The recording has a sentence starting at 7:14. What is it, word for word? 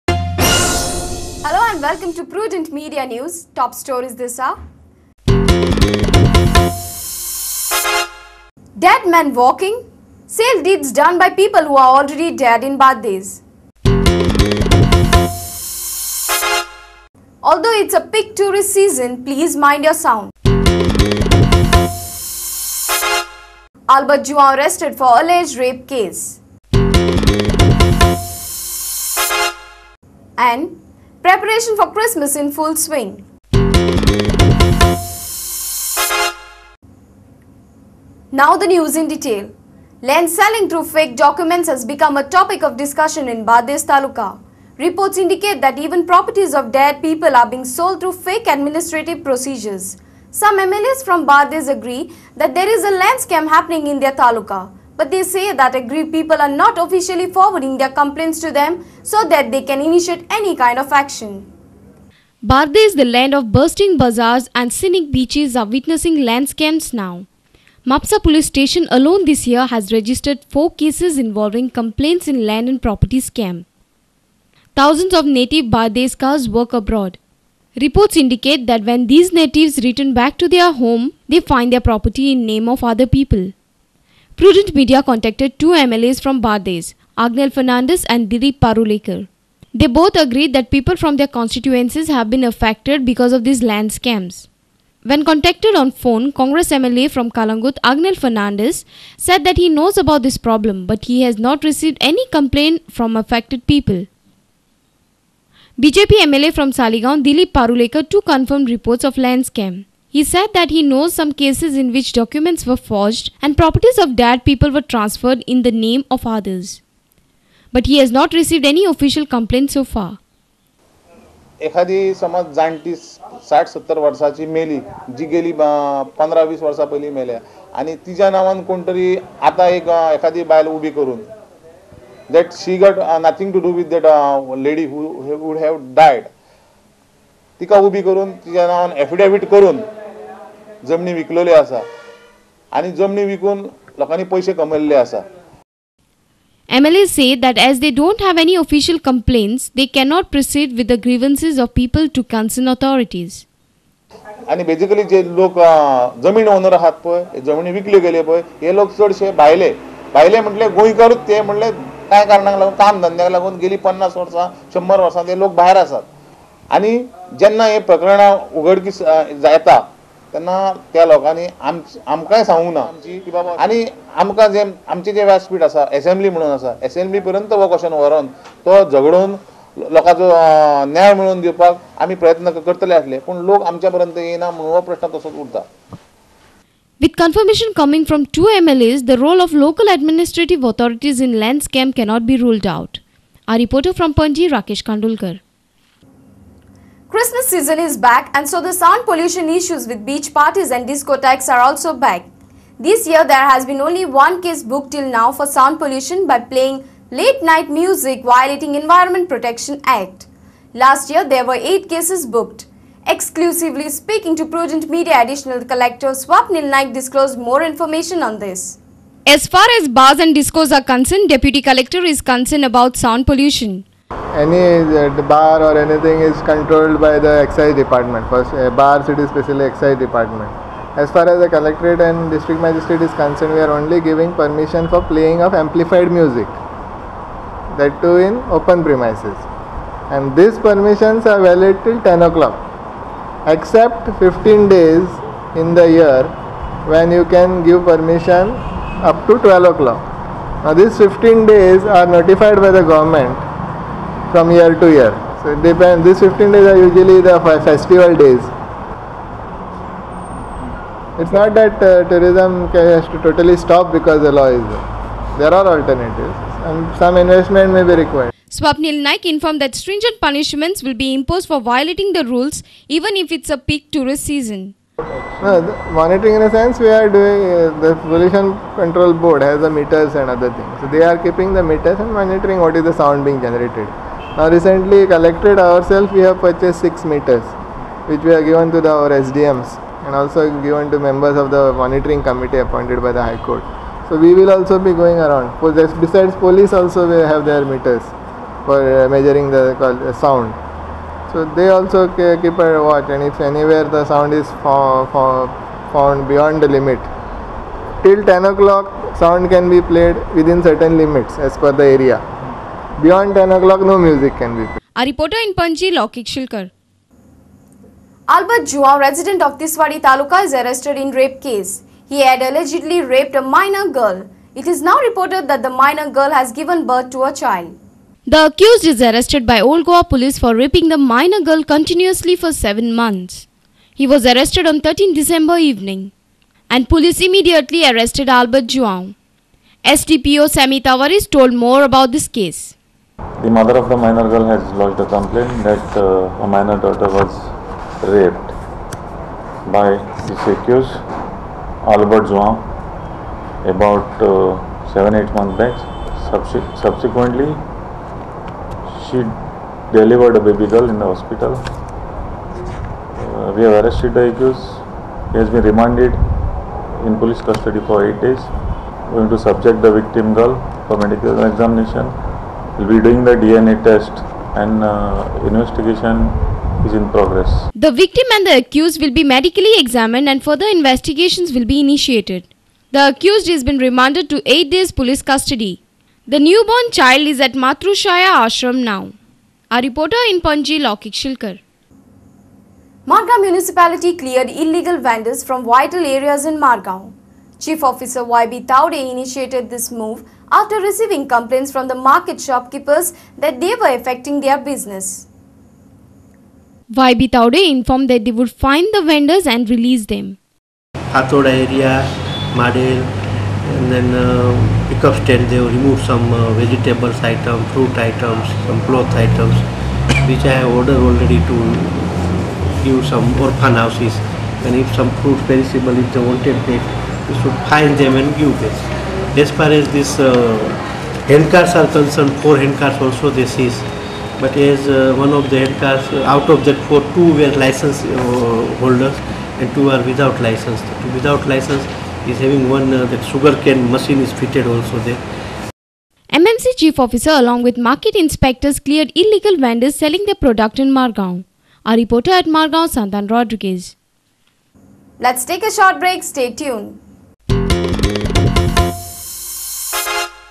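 But as uh, one of the handcars, uh, out of that four, two were license holders and two are without license.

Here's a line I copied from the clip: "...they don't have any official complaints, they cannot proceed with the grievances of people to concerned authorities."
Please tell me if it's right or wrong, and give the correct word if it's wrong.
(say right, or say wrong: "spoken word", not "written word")
right.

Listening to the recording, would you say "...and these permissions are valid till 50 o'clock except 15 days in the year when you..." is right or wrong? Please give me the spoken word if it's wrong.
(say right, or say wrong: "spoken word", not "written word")
wrong: "10", not "50".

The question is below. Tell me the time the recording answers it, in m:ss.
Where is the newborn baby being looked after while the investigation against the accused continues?
6:27.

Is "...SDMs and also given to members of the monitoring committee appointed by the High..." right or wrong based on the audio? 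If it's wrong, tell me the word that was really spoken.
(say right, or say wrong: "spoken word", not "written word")
right.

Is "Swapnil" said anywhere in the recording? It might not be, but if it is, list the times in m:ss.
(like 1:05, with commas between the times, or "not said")
3:36, 4:28.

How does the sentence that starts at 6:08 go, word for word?
We are going to subject the victim girl for medical examination.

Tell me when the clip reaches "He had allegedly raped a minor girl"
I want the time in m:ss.
5:22.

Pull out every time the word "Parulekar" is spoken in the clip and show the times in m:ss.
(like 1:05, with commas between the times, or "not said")
1:28, 1:47.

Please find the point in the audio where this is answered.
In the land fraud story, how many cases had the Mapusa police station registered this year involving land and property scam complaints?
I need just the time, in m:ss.
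1:10.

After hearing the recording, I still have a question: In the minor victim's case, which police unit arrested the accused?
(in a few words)
Old Goa police.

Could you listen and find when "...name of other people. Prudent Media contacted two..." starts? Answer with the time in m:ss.
1:22.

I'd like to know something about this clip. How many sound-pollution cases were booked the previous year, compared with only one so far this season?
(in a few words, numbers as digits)
8.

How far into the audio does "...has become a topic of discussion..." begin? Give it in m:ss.
0:41.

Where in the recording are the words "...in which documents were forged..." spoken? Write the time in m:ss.
1:51.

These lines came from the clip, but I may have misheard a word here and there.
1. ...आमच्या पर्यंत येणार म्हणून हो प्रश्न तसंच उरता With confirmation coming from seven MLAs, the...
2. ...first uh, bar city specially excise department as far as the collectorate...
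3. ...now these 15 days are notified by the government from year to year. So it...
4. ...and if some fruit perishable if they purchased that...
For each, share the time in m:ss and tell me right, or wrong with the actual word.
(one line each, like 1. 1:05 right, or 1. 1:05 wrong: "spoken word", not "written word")
1. 3:03 wrong: "two", not "seven"
2. 3:48 right
3. 4:10 right
4. 7:04 wrong: "wanted", not "purchased".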